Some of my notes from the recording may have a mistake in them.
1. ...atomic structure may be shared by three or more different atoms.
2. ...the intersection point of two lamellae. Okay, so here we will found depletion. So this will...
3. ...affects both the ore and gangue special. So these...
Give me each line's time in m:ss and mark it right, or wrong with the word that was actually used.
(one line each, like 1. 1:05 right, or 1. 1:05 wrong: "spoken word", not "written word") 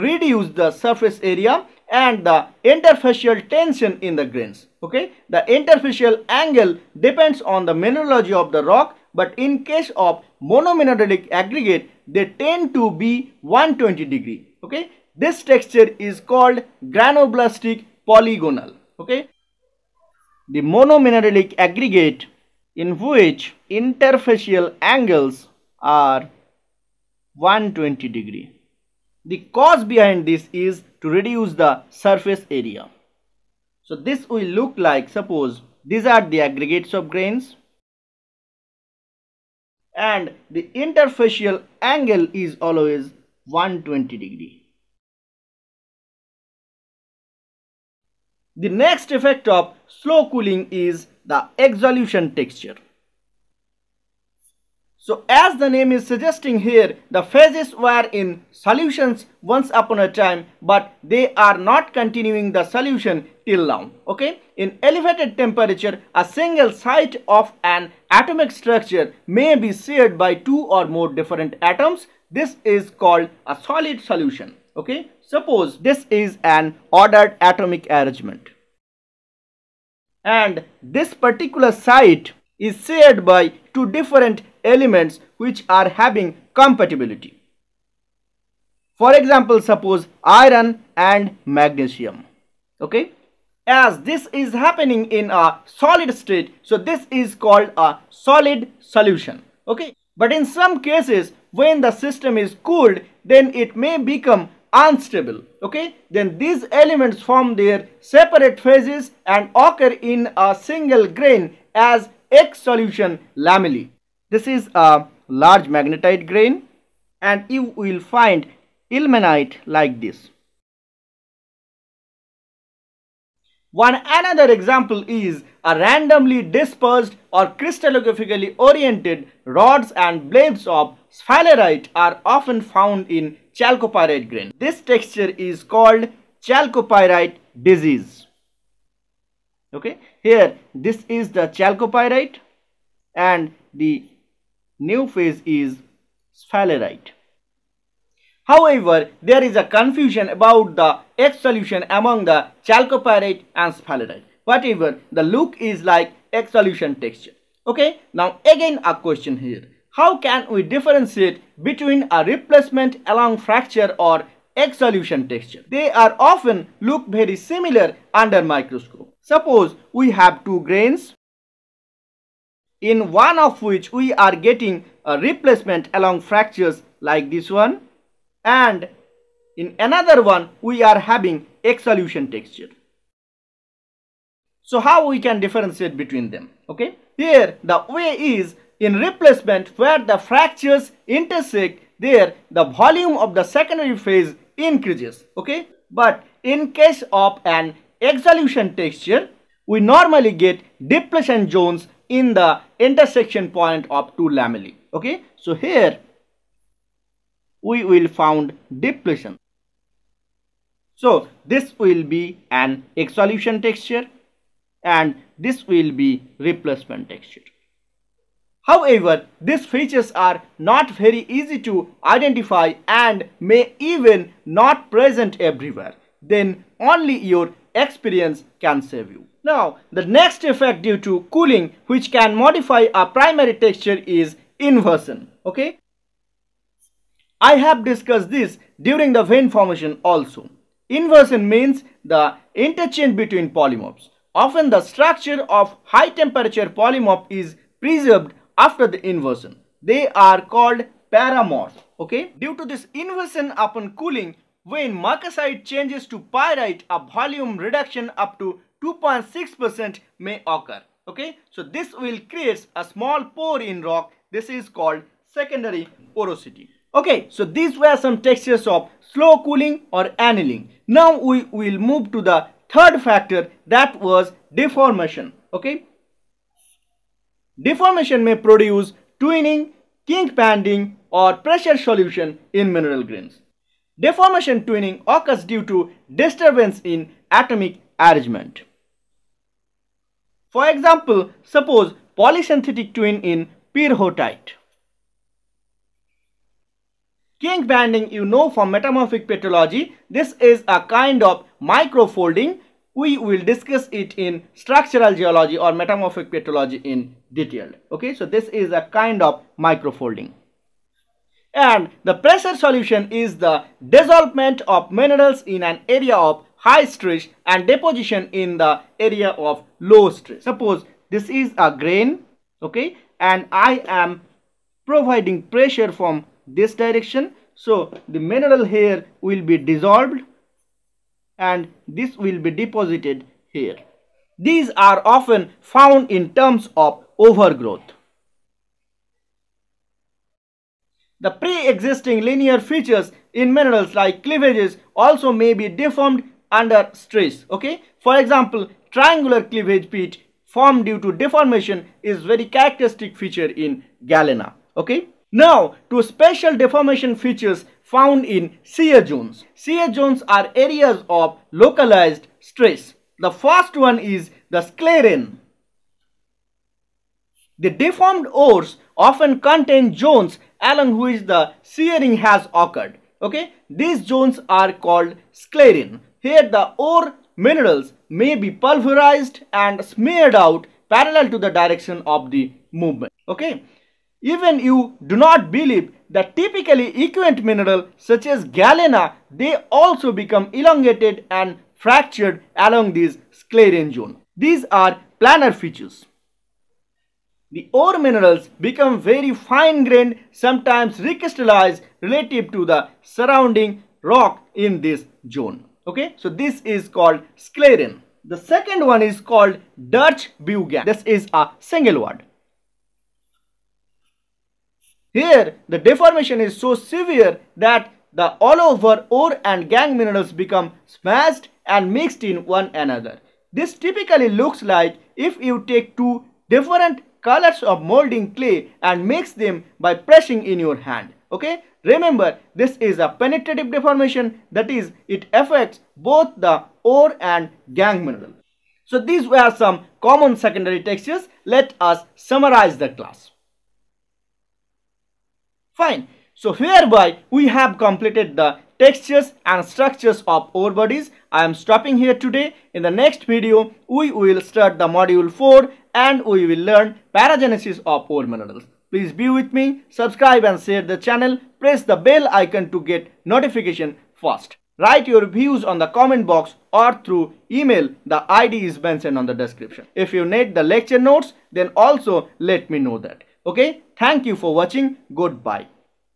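1. 1:08 wrong: "two", not "three"
2. 3:22 right
3. 7:15 wrong: "mineral", not "special".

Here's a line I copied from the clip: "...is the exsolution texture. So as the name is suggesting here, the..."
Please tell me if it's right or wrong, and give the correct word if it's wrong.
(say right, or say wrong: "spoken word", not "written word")
right.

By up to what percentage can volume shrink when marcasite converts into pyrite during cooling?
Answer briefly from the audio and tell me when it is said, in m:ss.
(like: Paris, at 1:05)
2.6%, at 4:18.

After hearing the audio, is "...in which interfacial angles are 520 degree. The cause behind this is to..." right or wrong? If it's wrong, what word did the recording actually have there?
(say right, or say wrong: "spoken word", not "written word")
wrong: "120", not "520".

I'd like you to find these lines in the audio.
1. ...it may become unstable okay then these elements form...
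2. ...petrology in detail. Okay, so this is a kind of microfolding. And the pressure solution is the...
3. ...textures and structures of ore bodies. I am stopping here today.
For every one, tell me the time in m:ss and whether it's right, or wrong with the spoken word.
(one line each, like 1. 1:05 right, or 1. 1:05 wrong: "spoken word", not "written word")
1. 1:43 right
2. 5:06 right
3. 7:28 right.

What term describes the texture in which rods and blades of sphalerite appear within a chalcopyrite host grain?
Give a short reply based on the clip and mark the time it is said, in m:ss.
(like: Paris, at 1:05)
chalcopyrite disease, at 2:16.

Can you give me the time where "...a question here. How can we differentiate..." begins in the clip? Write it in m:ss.
2:38.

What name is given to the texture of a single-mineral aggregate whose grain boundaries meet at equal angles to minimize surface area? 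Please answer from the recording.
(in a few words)
granoblastic polygonal.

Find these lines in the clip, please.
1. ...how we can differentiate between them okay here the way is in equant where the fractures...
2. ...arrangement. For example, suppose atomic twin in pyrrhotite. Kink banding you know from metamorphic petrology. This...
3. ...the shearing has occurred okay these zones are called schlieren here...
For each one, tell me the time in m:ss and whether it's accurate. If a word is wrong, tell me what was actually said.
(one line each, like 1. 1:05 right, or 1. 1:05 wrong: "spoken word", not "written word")
1. 3:04 wrong: "replacement", not "equant"
2. 4:47 wrong: "polysynthetic", not "atomic"
3. 6:11 right.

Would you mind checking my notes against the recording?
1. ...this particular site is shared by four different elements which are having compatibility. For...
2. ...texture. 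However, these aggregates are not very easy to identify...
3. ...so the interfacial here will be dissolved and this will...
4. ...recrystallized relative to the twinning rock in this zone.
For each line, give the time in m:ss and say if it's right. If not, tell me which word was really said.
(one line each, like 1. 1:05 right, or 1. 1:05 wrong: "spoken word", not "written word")
1. 1:20 wrong: "two", not "four"
2. 3:37 wrong: "features", not "aggregates"
3. 5:27 wrong: "mineral", not "interfacial"
4. 6:40 wrong: "surrounding", not "twinning".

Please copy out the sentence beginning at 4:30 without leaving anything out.
Now we will move to the third factor that was deformation.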